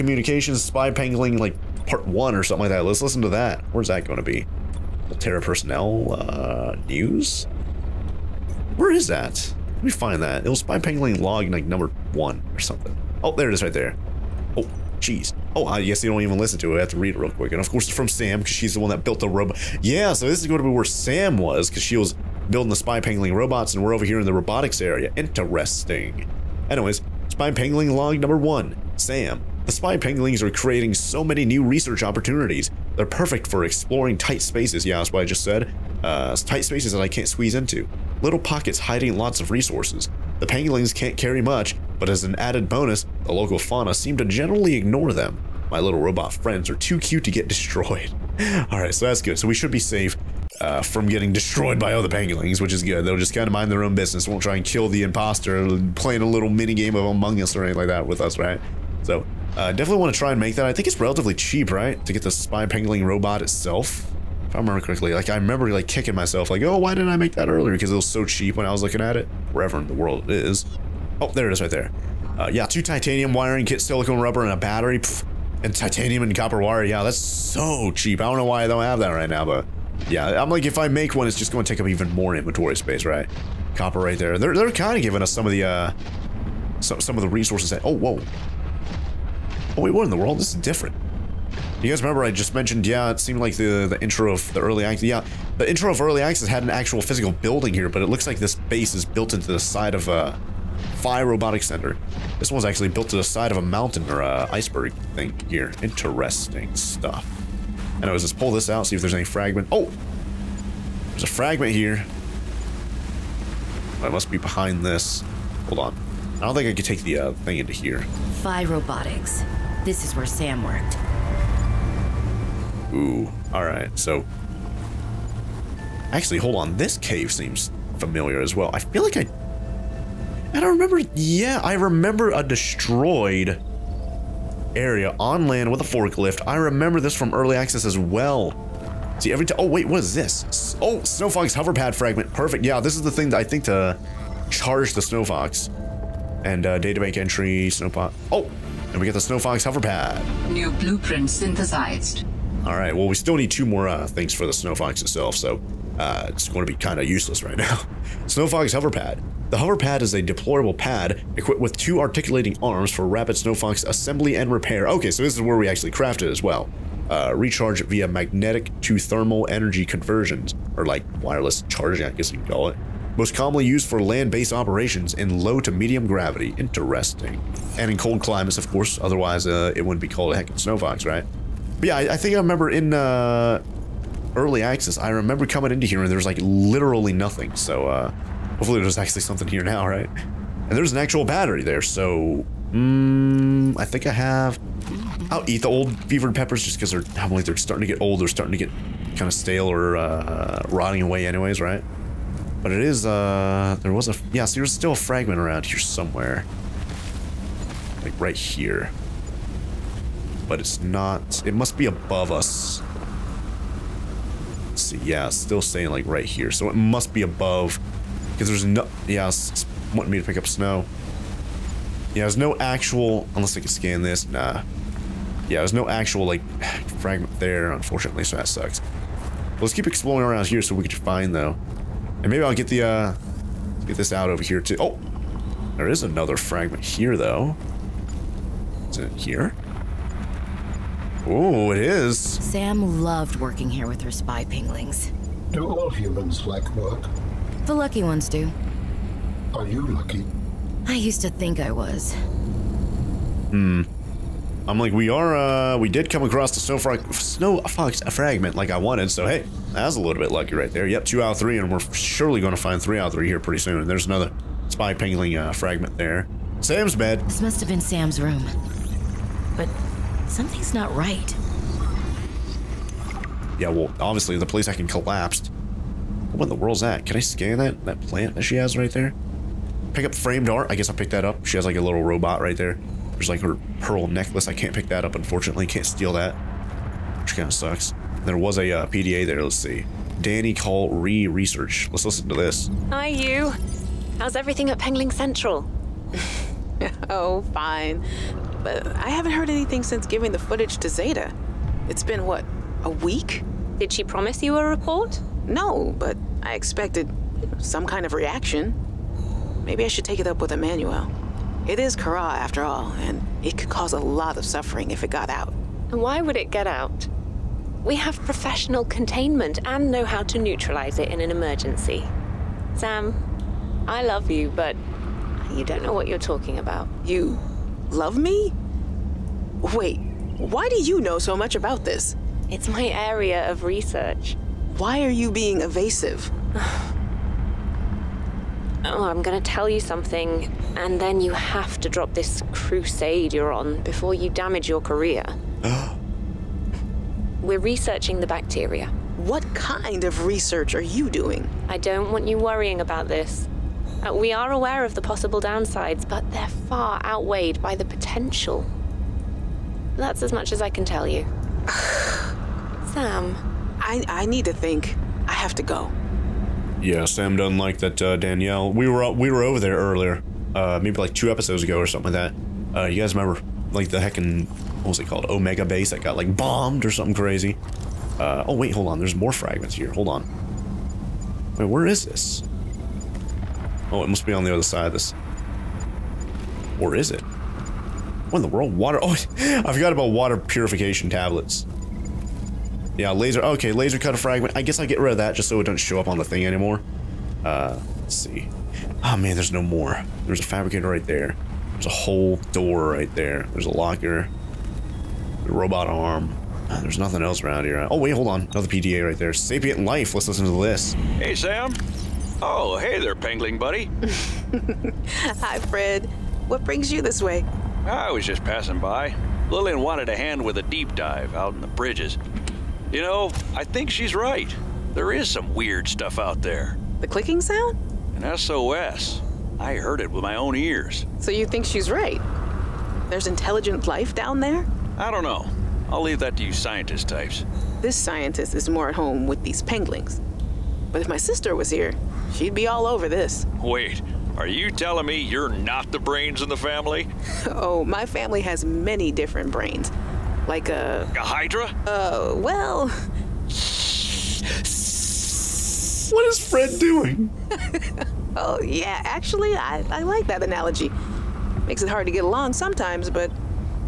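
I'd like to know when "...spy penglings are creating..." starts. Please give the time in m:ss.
0:29.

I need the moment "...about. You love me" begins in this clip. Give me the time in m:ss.
5:26.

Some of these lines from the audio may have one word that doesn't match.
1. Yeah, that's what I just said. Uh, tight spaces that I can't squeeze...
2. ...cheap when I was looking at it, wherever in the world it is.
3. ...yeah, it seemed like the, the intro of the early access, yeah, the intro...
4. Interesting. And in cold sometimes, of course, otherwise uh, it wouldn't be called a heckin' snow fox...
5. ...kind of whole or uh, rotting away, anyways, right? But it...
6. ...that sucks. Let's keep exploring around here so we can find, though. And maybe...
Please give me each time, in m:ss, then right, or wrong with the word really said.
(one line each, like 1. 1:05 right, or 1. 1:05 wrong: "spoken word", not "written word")
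1. 0:34 right
2. 1:08 right
3. 1:32 right
4. 2:56 wrong: "climates", not "sometimes"
5. 3:19 wrong: "stale", not "whole"
6. 3:48 right.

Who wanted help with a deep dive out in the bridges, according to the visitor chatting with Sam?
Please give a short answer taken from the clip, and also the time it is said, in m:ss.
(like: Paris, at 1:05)
Lillian, at 6:59.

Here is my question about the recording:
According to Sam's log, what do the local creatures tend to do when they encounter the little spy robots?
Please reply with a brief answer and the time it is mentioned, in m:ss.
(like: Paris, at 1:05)
Ignore them, at 0:44.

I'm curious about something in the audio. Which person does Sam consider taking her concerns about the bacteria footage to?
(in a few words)
Emmanuel.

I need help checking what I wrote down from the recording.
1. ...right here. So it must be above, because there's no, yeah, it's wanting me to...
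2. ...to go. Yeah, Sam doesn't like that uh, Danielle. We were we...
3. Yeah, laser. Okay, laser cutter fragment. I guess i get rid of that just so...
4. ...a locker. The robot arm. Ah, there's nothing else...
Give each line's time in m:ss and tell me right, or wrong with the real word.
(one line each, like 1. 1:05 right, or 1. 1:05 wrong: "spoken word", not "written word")
1. 3:36 right
2. 6:05 right
3. 6:32 right
4. 6:43 right.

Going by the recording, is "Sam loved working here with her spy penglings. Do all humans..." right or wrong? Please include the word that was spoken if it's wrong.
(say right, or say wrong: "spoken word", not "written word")
right.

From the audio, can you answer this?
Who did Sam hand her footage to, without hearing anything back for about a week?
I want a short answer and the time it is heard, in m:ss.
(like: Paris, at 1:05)
Zeta, at 5:00.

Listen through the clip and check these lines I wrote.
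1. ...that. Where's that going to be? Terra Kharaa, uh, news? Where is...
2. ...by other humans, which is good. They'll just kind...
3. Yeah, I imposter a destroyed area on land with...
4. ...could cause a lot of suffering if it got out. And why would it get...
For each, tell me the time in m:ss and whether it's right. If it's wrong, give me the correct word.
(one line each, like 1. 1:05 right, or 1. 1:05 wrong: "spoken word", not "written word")
1. 0:03 wrong: "Personnel", not "Kharaa"
2. 0:51 wrong: "pangolins", not "humans"
3. 2:11 wrong: "remember", not "imposter"
4. 5:13 right.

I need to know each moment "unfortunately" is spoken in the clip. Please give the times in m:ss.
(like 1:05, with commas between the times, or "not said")
3:47, 4:45.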